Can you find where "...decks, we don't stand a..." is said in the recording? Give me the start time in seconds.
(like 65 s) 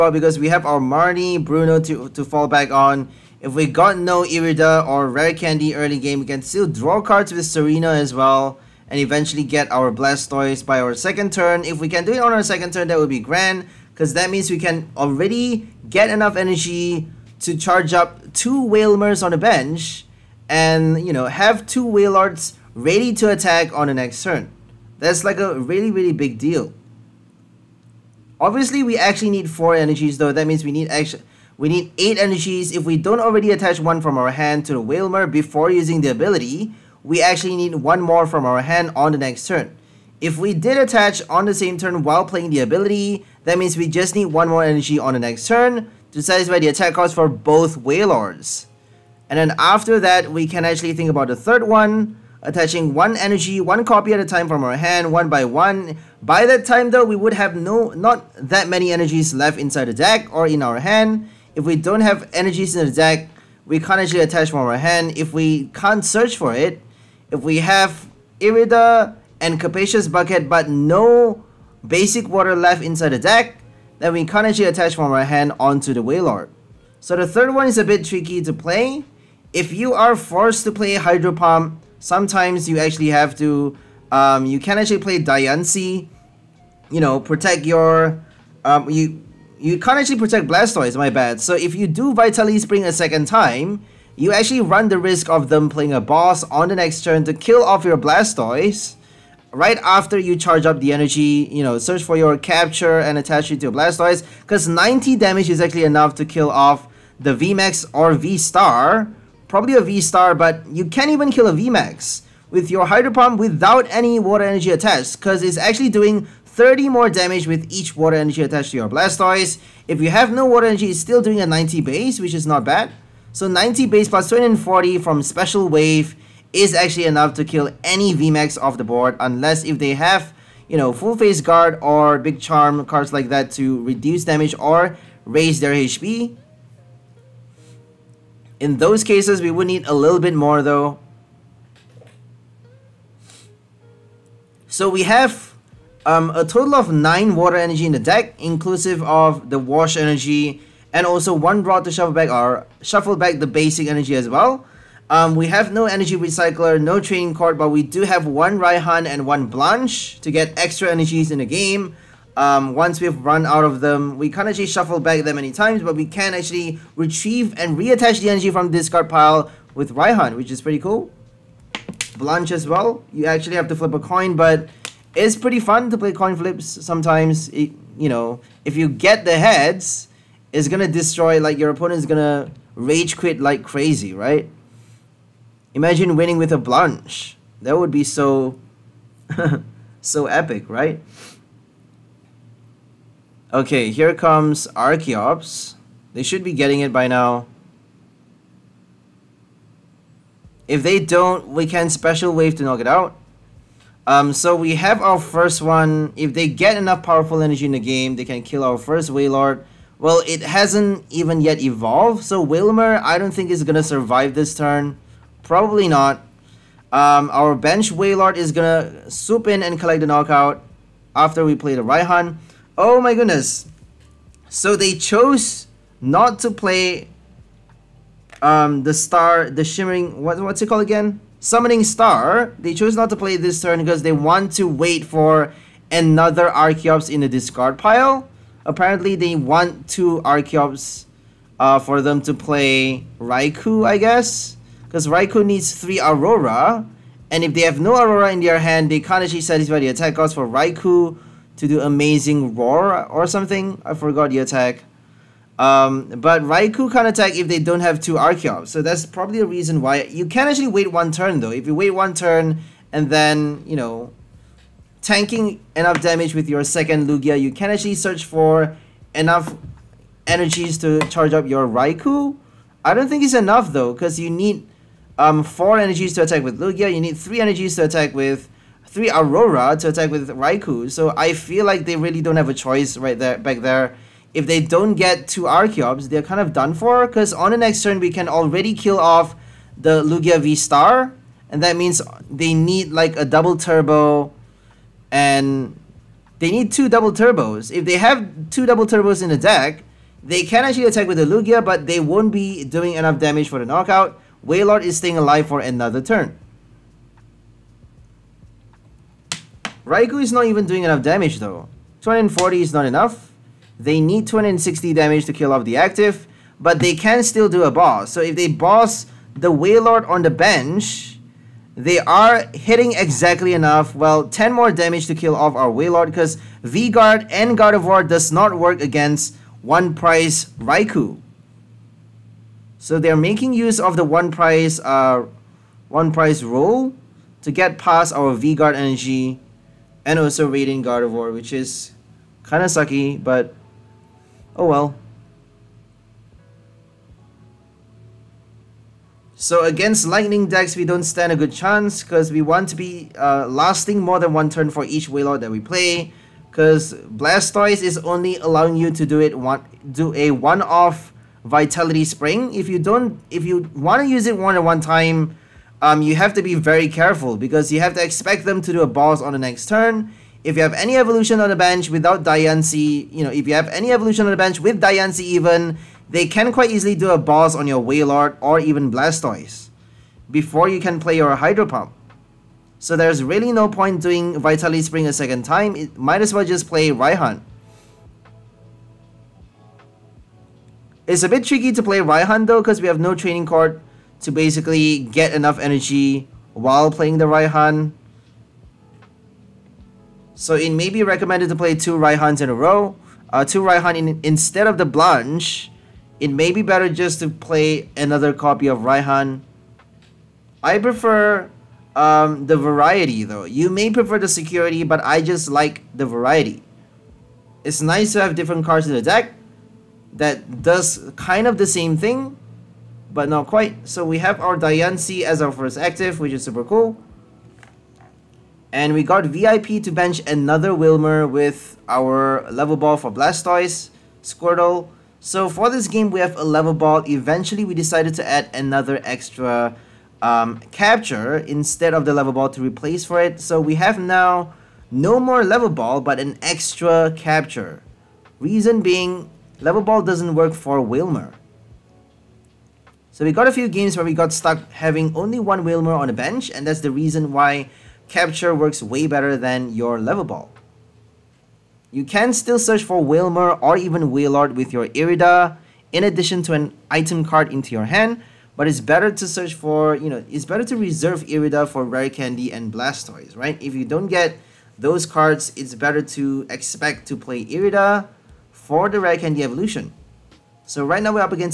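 350 s.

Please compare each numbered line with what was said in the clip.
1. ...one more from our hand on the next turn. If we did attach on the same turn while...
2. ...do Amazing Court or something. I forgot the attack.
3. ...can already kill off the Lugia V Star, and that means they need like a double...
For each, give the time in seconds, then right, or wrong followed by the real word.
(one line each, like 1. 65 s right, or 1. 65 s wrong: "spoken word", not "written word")
1. 37 s right
2. 251 s wrong: "Roar", not "Court"
3. 288 s right.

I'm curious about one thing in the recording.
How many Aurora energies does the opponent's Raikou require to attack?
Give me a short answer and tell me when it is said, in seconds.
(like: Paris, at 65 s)
3, at 245 s.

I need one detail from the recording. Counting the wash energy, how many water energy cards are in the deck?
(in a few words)
9.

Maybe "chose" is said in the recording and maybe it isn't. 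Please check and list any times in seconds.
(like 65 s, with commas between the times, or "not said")
224 s, 232 s.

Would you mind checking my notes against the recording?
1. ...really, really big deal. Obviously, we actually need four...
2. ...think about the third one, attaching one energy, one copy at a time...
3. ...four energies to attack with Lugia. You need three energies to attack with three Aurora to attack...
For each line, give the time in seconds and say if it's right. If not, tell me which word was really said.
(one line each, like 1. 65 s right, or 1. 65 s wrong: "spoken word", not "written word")
1. 25 s right
2. 50 s right
3. 275 s right.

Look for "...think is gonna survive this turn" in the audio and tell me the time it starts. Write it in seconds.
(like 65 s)
213 s.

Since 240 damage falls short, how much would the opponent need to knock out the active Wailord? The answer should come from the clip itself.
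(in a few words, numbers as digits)
260.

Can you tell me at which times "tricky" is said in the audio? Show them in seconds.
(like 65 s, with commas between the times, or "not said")
78 s, 391 s.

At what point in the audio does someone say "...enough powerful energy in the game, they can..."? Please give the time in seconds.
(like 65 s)
206 s.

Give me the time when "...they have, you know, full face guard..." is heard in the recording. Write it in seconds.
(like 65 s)
129 s.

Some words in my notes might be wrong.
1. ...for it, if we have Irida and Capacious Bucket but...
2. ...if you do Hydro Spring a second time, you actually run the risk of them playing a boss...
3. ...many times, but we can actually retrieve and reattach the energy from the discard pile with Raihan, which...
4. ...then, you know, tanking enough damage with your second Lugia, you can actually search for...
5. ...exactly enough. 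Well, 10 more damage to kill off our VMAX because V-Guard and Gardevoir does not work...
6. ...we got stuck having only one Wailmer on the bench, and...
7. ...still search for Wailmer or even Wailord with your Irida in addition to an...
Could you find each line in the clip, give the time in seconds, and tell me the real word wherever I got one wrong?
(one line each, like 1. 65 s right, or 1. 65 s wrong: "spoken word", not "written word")
1. 66 s right
2. 91 s wrong: "Vitality", not "Hydro"
3. 165 s right
4. 263 s right
5. 322 s wrong: "Wailord", not "VMAX"
6. 454 s right
7. 462 s right.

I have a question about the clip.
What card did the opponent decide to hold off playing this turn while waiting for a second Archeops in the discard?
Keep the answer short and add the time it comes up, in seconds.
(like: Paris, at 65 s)
Summoning Star, at 231 s.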